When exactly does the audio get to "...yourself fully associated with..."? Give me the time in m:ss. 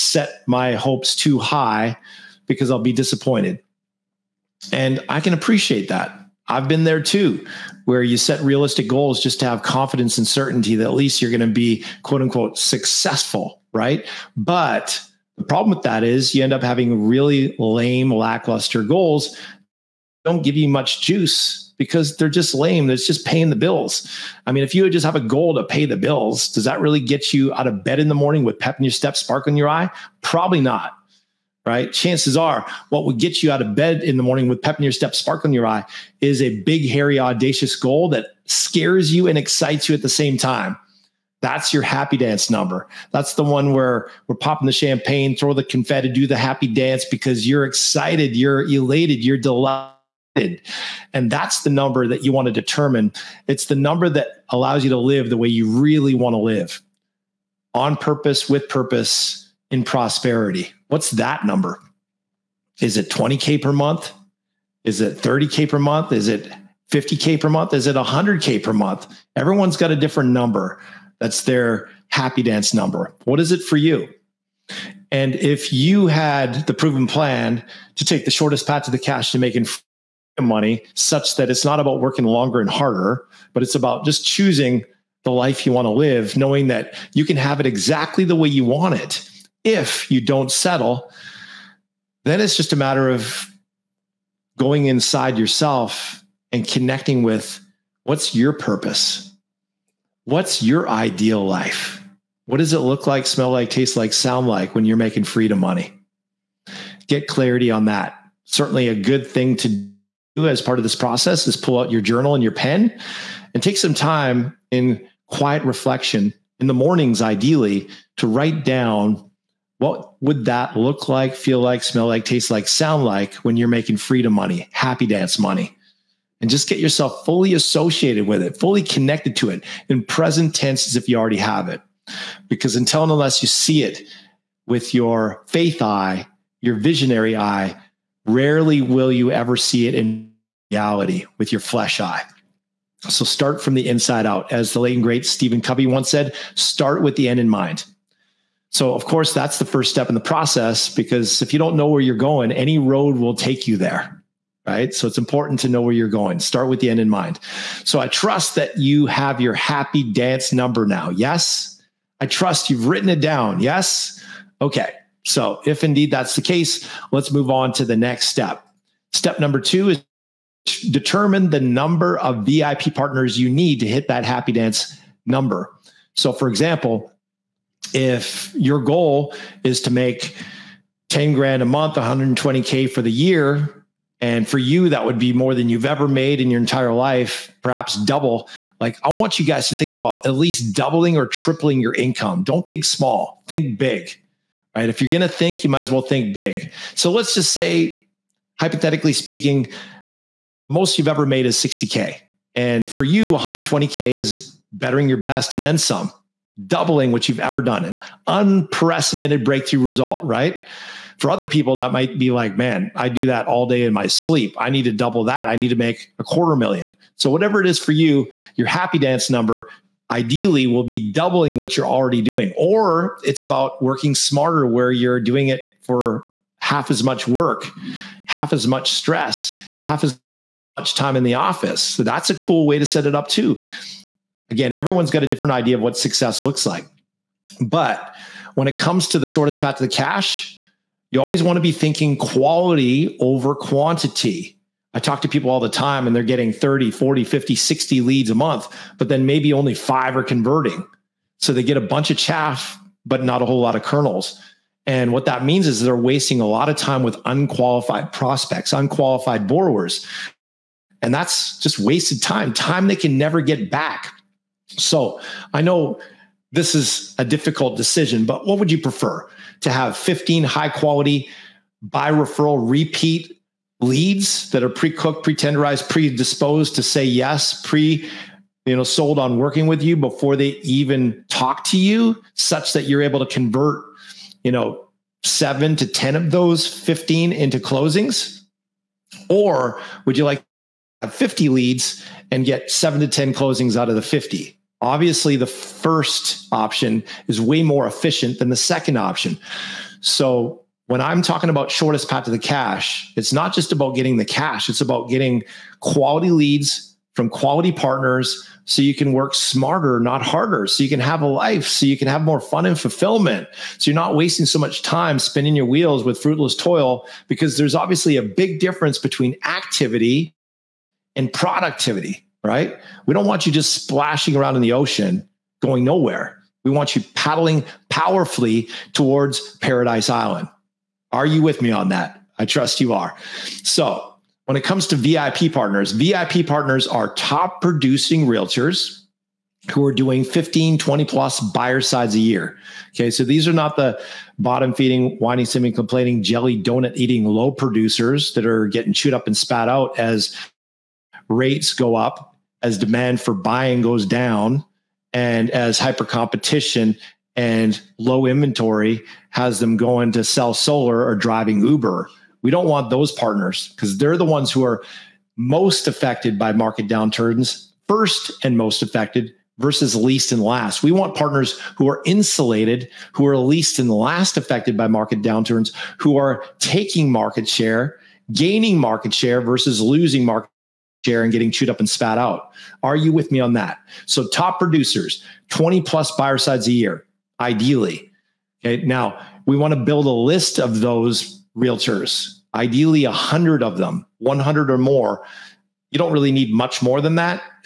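2:06.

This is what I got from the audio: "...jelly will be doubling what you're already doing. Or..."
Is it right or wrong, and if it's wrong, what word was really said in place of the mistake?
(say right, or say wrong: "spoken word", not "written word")
wrong: "ideally", not "jelly".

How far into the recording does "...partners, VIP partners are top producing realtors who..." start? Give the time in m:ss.
5:35.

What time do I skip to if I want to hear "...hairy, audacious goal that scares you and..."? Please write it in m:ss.
0:36.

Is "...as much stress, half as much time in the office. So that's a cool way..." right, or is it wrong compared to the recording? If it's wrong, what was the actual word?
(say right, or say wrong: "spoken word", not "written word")
right.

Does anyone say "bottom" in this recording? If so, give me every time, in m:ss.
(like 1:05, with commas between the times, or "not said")
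5:44.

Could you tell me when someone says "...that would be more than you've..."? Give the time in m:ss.
3:04.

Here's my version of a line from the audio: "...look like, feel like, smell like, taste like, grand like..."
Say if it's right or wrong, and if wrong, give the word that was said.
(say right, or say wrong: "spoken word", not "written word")
wrong: "sound", not "grand".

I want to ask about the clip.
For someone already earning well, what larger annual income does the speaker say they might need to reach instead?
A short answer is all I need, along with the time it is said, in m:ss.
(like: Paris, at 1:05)
a quarter million, at 3:36.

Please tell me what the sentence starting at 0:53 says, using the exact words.
It's the number that allows you to live the way you really want to live on purpose, with purpose, in prosperity.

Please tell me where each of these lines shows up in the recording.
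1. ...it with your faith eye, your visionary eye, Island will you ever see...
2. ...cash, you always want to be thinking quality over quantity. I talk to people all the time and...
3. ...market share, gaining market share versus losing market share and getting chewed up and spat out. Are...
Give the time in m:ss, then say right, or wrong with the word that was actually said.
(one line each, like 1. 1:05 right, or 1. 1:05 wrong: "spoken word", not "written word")
1. 2:13 wrong: "Rarely", not "Island"
2. 3:59 right
3. 6:17 right.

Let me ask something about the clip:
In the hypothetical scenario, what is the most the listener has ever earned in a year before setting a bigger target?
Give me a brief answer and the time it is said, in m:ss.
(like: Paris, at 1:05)
60K, at 3:21.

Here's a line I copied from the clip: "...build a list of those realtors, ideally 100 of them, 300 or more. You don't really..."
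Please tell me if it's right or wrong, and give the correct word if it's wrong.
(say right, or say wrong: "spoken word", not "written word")
wrong: "100", not "300".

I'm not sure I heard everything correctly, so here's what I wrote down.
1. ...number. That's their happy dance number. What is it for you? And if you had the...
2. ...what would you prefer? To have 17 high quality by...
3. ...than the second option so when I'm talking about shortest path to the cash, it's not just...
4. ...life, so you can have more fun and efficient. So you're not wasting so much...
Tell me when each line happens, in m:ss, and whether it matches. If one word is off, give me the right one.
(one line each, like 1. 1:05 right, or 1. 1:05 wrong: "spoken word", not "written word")
1. 1:10 right
2. 4:28 wrong: "15", not "17"
3. 4:58 right
4. 5:11 wrong: "fulfillment", not "efficient".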